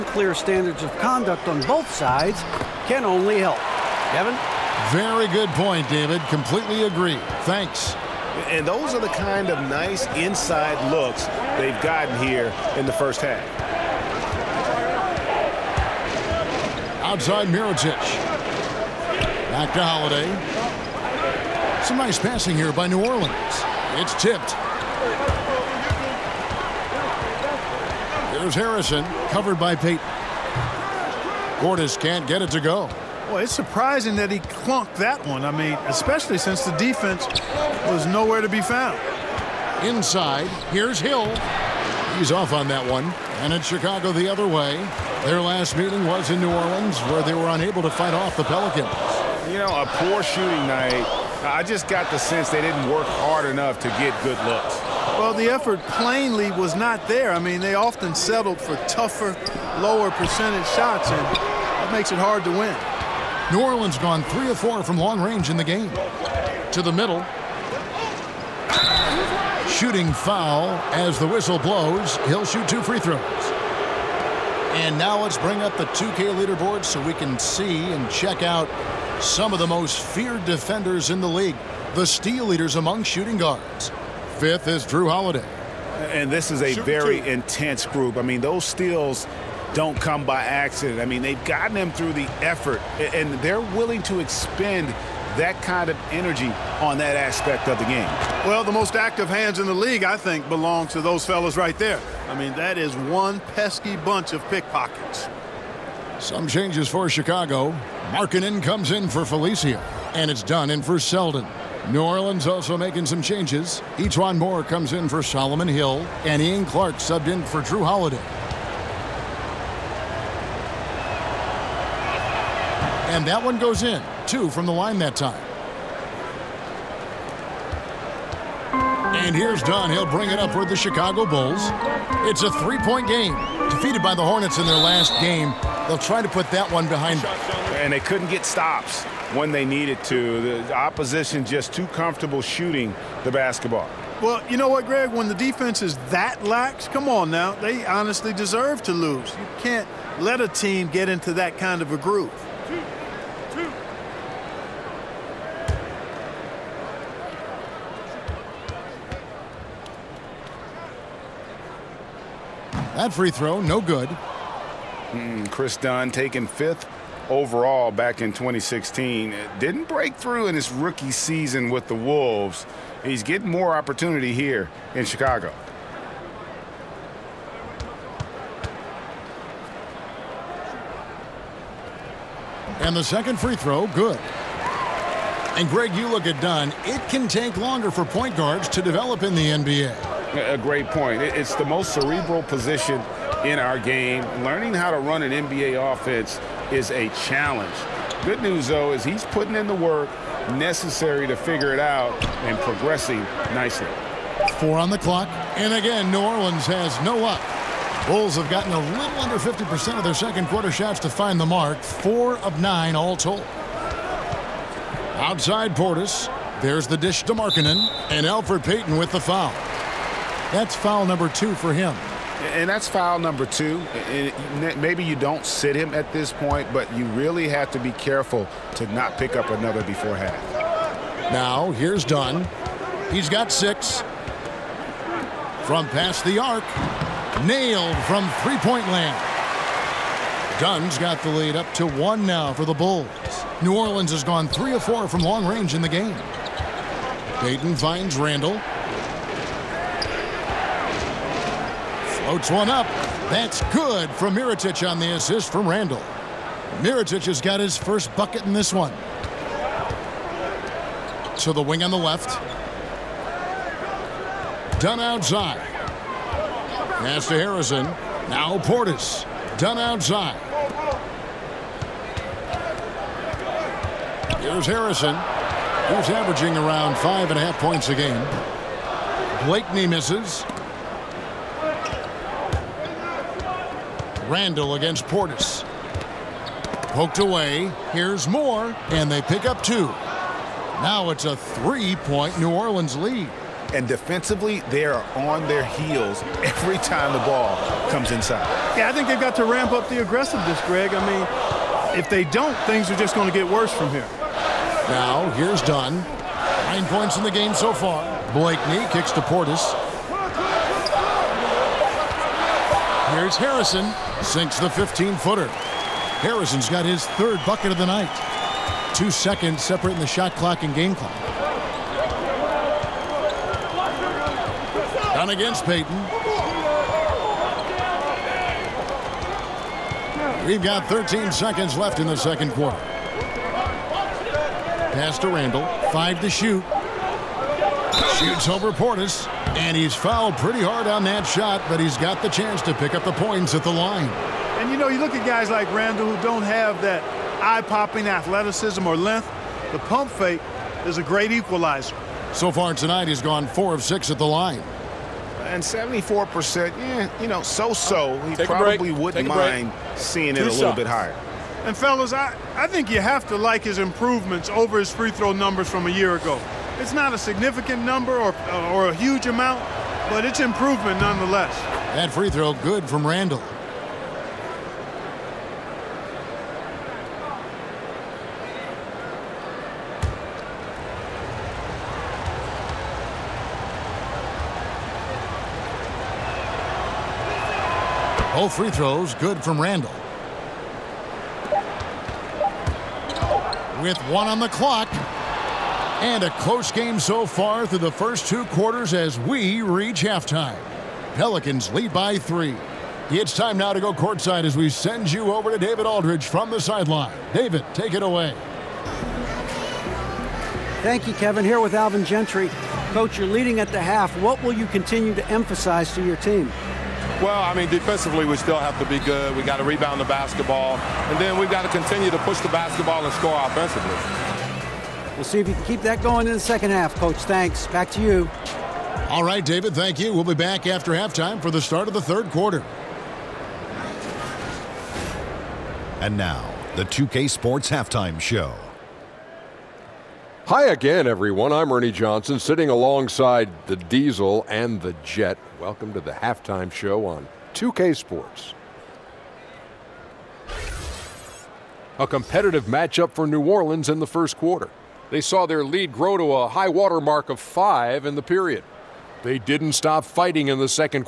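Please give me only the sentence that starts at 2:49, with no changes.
Didn't break through in his rookie season with the Wolves.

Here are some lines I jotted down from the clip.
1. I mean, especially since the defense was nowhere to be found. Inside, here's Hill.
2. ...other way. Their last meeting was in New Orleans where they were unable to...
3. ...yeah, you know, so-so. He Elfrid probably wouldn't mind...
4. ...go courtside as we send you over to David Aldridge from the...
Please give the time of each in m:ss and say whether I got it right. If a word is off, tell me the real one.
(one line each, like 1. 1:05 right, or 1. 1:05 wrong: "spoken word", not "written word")
1. 0:35 right
2. 0:44 right
3. 5:56 wrong: "Take", not "Elfrid"
4. 6:43 right.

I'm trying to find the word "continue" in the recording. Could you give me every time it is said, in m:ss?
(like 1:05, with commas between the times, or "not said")
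6:54, 7:01.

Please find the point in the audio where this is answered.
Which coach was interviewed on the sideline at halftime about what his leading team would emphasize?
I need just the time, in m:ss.
6:51.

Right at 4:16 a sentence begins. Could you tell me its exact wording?
Mirotic has got his first bucket in this one.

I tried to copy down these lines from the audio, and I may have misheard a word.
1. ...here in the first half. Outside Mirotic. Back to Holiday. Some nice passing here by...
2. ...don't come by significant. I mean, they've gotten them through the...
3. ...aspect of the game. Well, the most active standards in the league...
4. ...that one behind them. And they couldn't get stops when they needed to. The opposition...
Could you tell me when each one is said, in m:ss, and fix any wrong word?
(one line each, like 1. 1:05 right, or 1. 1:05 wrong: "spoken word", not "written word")
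1. 0:12 right
2. 1:29 wrong: "accident", not "significant"
3. 1:37 wrong: "hands", not "standards"
4. 2:16 right.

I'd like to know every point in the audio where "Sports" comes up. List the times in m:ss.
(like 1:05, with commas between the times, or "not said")
7:17, 7:27.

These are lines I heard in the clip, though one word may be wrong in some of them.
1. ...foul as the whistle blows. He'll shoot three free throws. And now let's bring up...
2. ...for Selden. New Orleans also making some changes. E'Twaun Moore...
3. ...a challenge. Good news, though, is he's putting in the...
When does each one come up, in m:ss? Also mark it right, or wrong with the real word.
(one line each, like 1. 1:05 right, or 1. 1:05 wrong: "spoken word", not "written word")
1. 1:10 wrong: "two", not "three"
2. 1:50 right
3. 3:16 right.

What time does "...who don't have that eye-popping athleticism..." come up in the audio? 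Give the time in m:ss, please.
5:46.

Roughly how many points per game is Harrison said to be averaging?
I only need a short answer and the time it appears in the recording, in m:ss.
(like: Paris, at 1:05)
5.5, at 4:36.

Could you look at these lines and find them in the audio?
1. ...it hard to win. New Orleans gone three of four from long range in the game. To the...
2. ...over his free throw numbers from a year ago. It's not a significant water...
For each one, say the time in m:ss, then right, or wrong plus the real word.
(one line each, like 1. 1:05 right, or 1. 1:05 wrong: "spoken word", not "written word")
1. 1:02 right
2. 6:04 wrong: "number", not "water".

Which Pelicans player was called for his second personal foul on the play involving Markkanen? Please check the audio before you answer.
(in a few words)
Elfrid Payton.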